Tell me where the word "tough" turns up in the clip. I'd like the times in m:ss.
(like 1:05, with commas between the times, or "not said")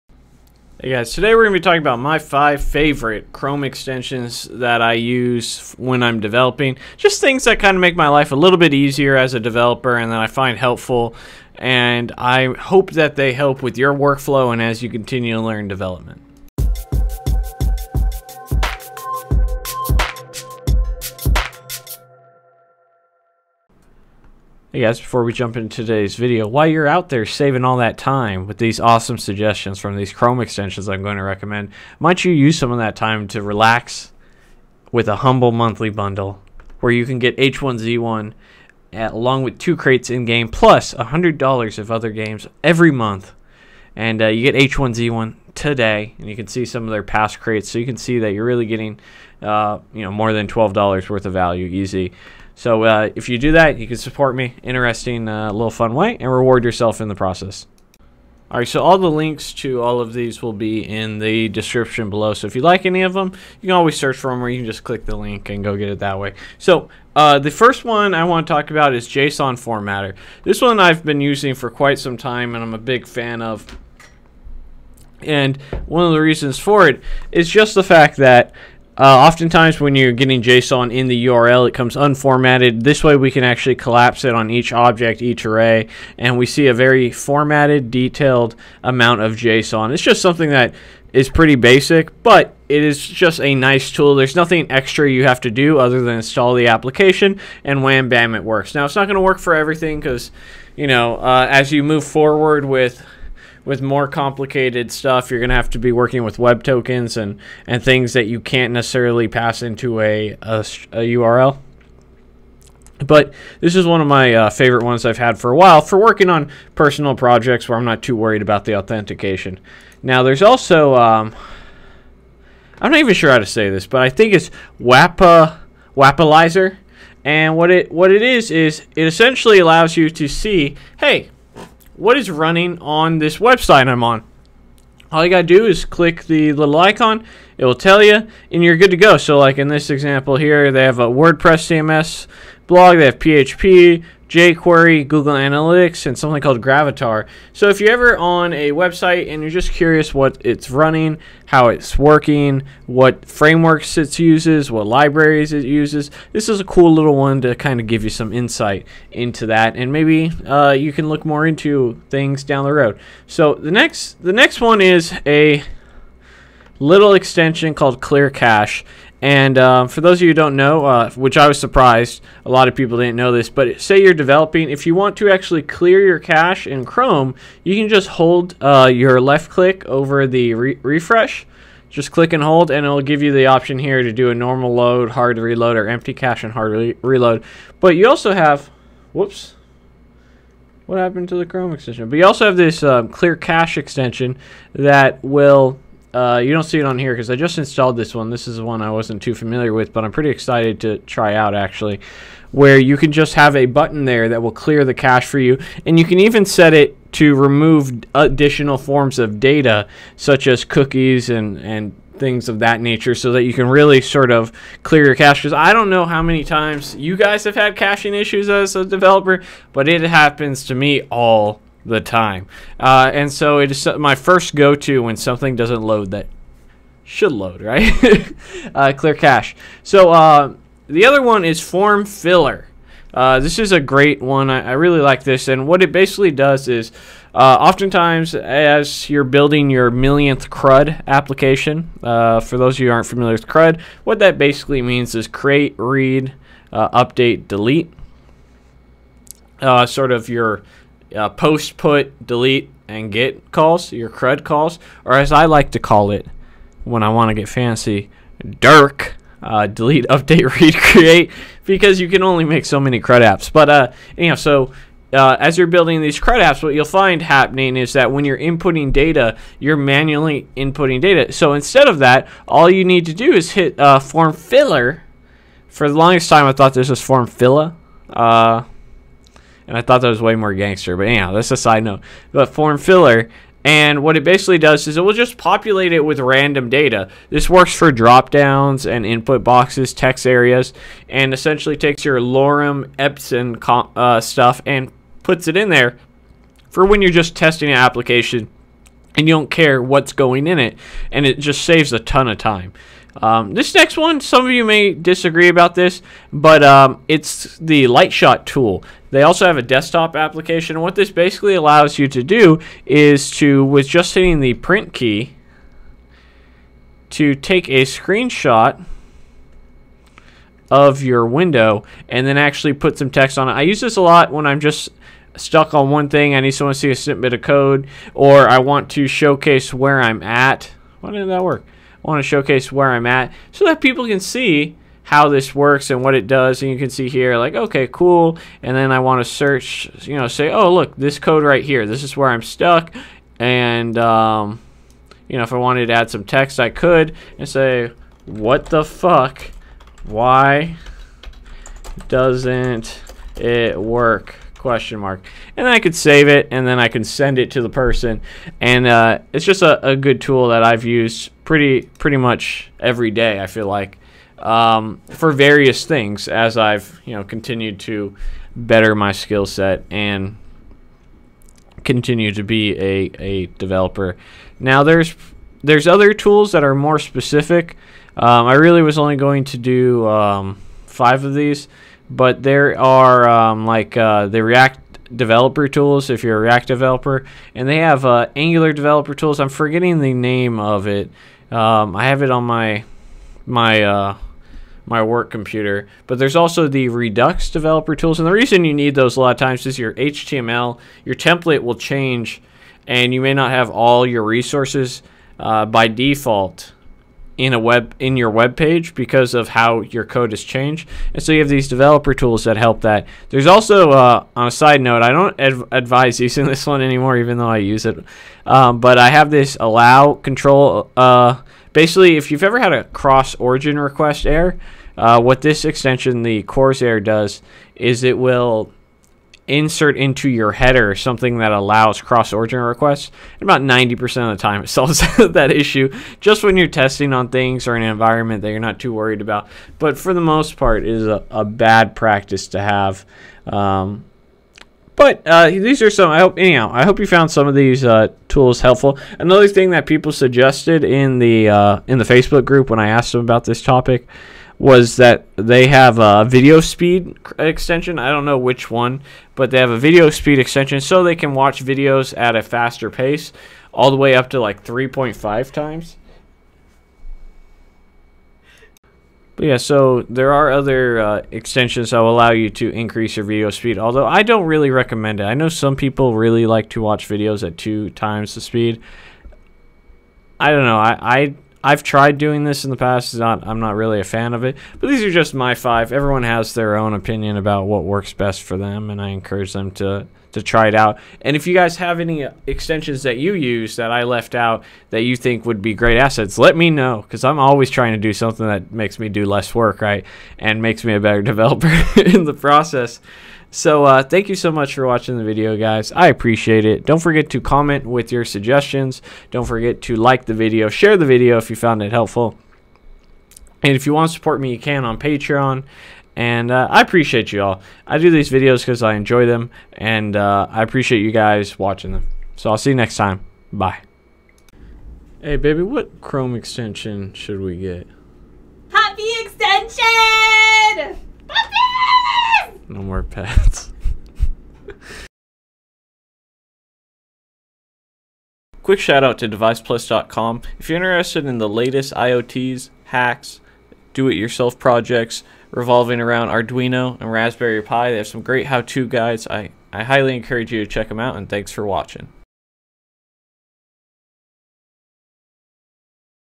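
not said.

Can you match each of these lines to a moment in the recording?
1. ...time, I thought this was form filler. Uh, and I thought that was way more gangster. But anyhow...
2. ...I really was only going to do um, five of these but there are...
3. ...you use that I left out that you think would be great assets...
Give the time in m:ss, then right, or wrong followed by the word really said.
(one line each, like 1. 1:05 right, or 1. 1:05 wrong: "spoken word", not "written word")
1. 4:36 right
2. 6:18 right
3. 8:13 right.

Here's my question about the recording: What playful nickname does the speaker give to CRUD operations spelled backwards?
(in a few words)
Dirk.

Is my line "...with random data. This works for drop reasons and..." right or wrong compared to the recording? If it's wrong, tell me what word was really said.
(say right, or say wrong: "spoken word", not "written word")
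wrong: "downs", not "reasons".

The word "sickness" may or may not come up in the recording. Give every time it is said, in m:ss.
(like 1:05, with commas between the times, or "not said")
not said.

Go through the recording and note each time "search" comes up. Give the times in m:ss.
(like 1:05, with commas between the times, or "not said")
1:03, 5:39.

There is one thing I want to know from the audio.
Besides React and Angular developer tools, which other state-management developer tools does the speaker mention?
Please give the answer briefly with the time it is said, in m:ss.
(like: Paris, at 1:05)
Redux developer tools, at 6:36.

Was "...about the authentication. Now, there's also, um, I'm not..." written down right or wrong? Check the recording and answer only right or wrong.
right.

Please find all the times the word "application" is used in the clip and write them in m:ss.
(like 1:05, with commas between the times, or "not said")
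1:36, 4:01, 4:57, 5:10.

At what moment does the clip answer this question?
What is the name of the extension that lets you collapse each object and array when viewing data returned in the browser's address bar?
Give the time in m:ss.
1:09.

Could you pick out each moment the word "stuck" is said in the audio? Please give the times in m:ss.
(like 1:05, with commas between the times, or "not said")
5:25, 5:42.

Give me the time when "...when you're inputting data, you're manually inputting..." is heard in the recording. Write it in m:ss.
4:28.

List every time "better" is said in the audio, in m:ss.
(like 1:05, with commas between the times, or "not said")
6:08, 8:21.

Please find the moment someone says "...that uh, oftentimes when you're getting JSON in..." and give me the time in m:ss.
1:18.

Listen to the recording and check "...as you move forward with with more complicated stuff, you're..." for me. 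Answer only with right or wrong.
right.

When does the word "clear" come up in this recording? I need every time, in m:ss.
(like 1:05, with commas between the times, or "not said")
2:47, 2:55, 3:13, 3:24, 3:34, 3:48.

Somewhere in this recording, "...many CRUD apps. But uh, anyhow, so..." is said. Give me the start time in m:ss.
4:22.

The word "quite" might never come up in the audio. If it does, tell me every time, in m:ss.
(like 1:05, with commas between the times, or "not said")
1:11.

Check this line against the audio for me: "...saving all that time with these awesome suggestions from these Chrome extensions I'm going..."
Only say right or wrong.
right.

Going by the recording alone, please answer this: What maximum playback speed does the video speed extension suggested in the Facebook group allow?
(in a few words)
3.5 times.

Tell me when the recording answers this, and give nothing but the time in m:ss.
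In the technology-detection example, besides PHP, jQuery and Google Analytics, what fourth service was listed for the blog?
2:26.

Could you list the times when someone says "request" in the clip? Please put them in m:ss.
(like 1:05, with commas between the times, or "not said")
7:03, 7:12.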